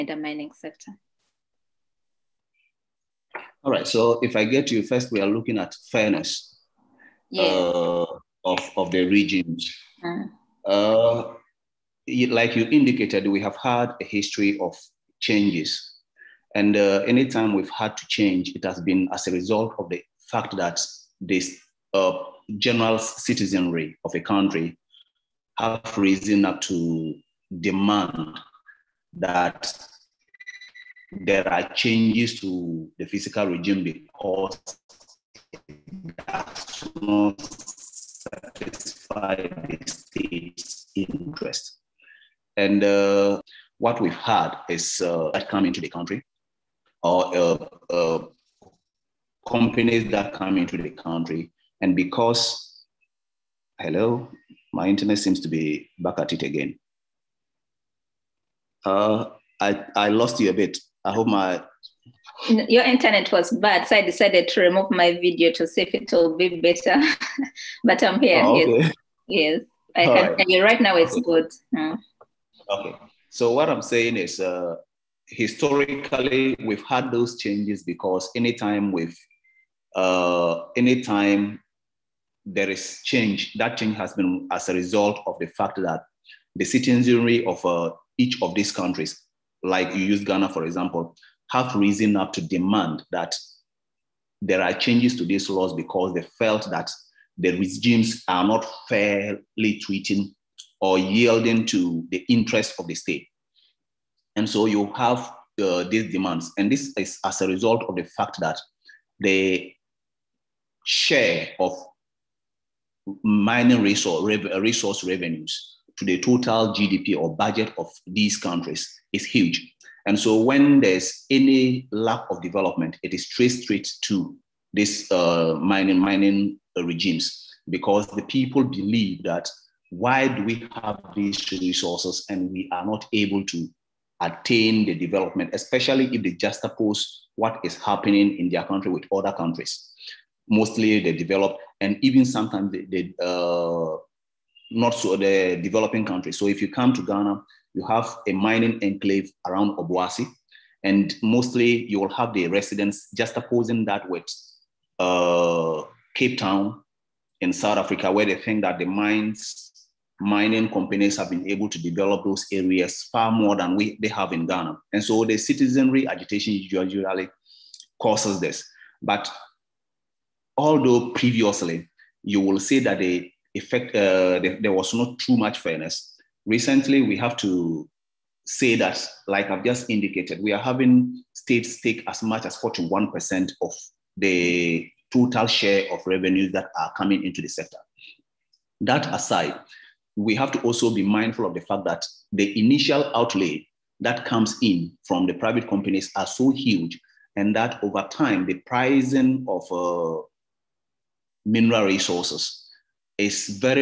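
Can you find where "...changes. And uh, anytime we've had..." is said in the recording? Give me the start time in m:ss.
0:15.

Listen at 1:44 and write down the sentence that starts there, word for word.
And so you have uh, these demands.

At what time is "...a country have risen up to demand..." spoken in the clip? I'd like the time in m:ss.
0:24.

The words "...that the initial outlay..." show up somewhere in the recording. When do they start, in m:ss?
3:11.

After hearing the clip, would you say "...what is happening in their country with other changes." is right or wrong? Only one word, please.
wrong.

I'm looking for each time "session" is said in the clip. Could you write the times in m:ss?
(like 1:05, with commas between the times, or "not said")
not said.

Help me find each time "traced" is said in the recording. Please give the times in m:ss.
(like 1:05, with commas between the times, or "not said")
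2:03.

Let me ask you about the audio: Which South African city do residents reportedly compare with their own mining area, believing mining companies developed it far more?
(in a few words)
Cape Town.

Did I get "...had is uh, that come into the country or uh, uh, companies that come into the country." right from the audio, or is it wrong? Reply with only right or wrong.
right.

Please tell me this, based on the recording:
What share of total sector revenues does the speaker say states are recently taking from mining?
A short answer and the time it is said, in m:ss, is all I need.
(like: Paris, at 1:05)
41%, at 3:02.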